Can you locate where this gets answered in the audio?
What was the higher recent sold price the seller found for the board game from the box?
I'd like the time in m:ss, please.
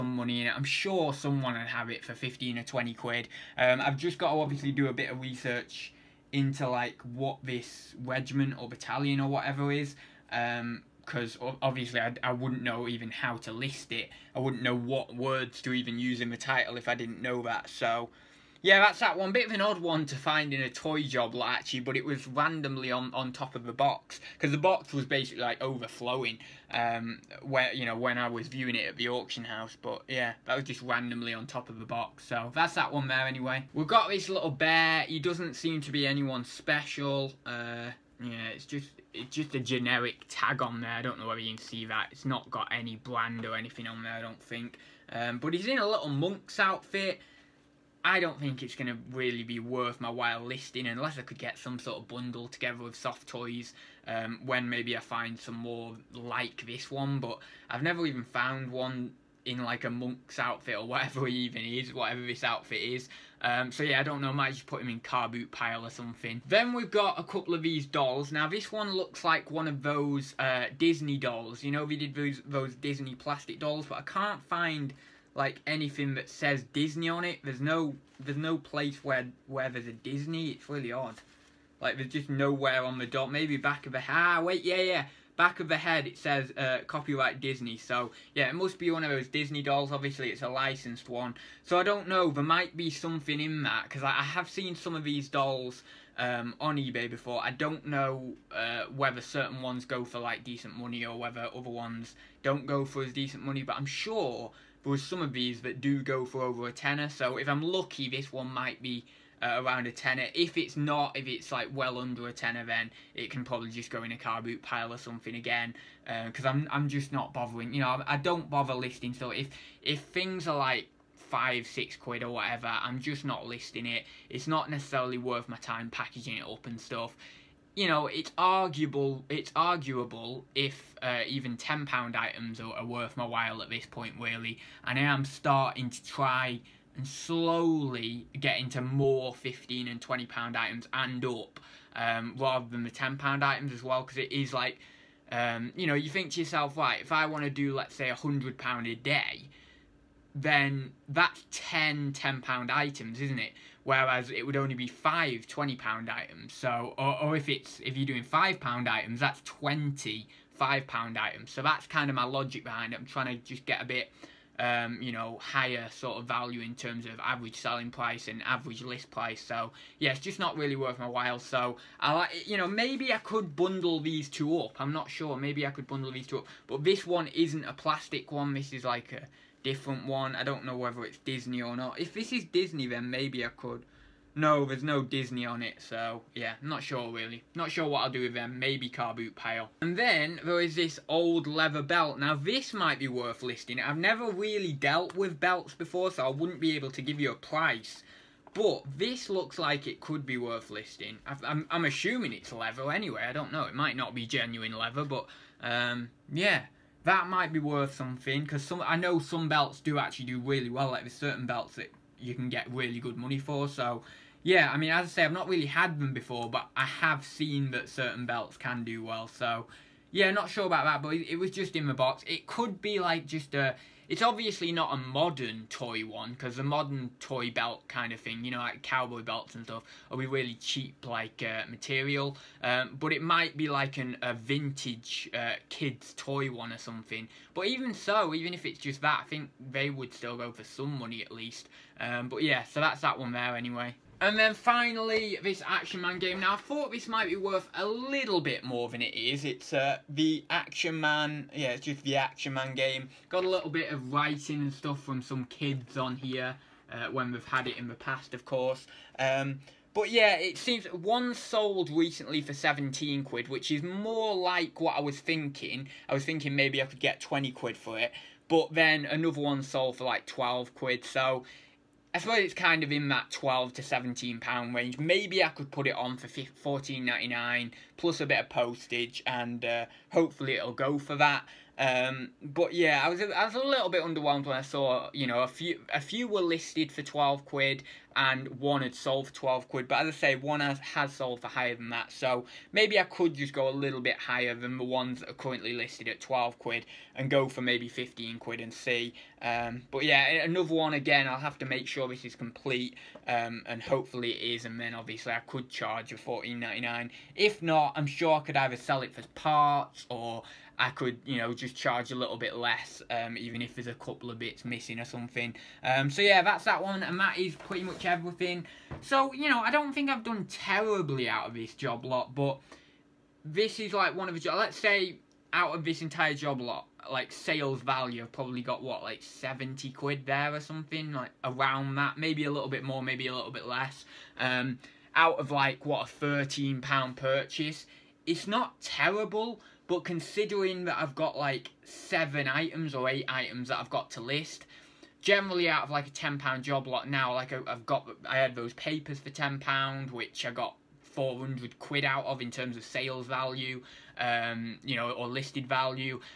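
4:22.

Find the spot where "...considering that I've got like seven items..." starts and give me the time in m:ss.
5:40.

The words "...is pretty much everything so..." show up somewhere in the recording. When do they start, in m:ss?
5:17.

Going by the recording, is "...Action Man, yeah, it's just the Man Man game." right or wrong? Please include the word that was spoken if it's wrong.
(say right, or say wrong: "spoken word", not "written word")
wrong: "Action", not "Man".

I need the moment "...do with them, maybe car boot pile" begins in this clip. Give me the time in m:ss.
3:08.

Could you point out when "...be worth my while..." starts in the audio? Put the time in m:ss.
0:49.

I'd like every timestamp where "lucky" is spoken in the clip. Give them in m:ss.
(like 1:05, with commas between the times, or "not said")
1:47.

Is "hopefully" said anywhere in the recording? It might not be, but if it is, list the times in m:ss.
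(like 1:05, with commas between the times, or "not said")
4:40, 5:03.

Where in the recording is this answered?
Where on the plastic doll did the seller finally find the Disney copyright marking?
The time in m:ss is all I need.
1:25.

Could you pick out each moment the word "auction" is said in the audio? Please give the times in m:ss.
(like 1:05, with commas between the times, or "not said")
0:29.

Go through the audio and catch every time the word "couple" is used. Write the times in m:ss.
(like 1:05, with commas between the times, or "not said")
1:07, 5:13.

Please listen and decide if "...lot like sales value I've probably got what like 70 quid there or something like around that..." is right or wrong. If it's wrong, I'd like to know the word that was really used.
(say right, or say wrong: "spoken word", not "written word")
right.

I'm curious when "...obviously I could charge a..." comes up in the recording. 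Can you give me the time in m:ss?
5:04.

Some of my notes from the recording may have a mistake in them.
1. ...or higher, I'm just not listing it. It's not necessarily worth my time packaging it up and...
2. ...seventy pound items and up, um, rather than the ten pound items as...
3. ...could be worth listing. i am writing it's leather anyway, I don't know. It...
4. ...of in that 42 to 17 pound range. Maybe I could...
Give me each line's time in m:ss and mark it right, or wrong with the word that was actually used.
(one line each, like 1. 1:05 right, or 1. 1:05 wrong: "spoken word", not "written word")
1. 2:02 wrong: "whatever", not "higher"
2. 2:20 wrong: "twenty", not "seventy"
3. 3:19 wrong: "assuming", not "writing"
4. 4:32 wrong: "12", not "42".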